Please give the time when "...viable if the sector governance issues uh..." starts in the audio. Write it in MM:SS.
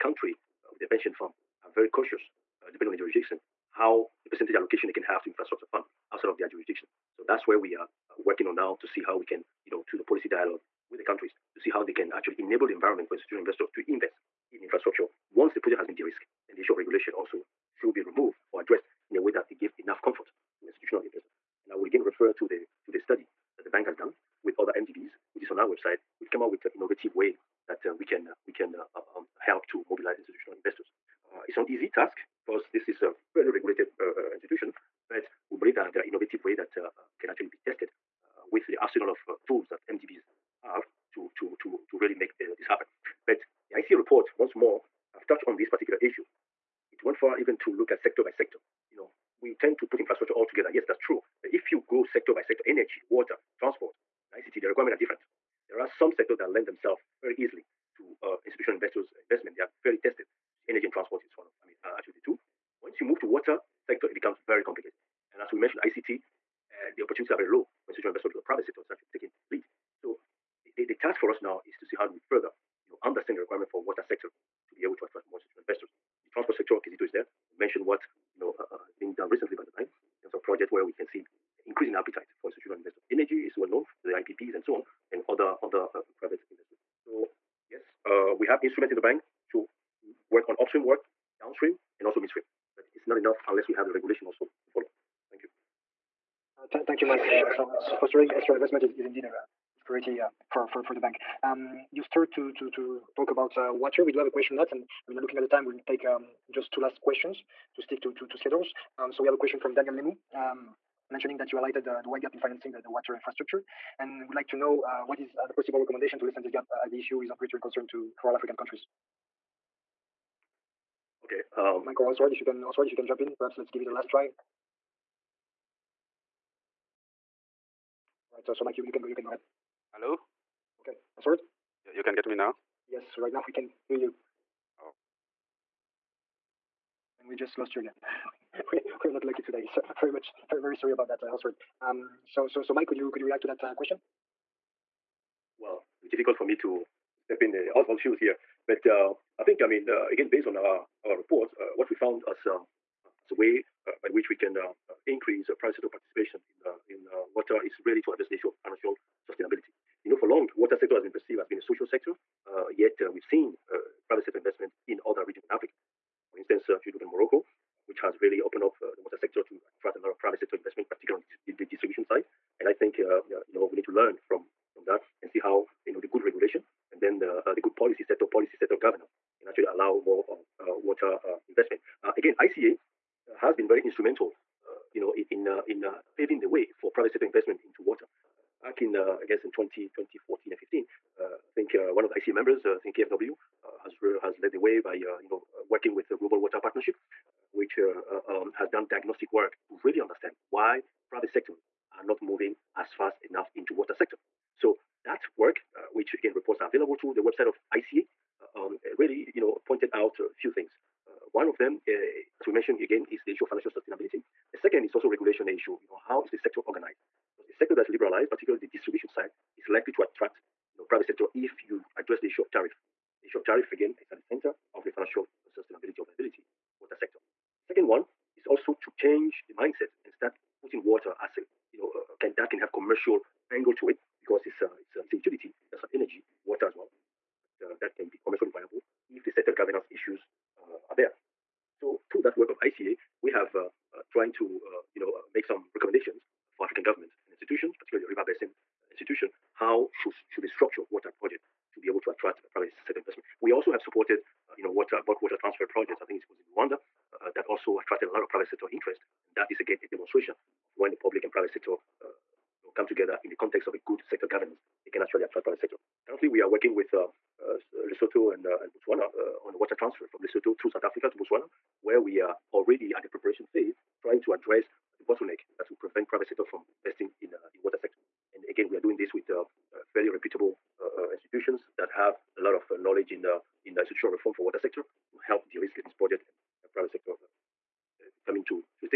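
03:58.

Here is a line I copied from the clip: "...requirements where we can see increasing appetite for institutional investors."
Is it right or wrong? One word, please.
wrong.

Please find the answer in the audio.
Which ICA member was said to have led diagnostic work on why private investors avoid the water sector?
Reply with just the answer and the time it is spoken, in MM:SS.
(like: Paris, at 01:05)
KFW, at 03:12.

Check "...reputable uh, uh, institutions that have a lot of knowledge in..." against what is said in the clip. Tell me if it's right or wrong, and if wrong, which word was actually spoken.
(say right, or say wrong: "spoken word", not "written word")
right.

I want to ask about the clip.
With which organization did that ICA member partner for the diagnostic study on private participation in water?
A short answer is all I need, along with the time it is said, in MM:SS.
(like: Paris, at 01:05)
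Global Water Partnership, at 03:16.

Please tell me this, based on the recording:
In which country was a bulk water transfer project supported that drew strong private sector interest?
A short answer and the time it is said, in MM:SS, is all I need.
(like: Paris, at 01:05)
Rwanda, at 04:16.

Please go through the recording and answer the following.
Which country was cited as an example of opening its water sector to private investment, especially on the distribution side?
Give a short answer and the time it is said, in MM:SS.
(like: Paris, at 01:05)
Morocco, at 02:47.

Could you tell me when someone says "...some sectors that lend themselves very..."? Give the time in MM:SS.
00:55.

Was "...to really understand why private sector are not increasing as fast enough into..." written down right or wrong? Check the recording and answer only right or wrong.
wrong.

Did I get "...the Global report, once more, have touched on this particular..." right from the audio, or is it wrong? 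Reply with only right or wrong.
wrong.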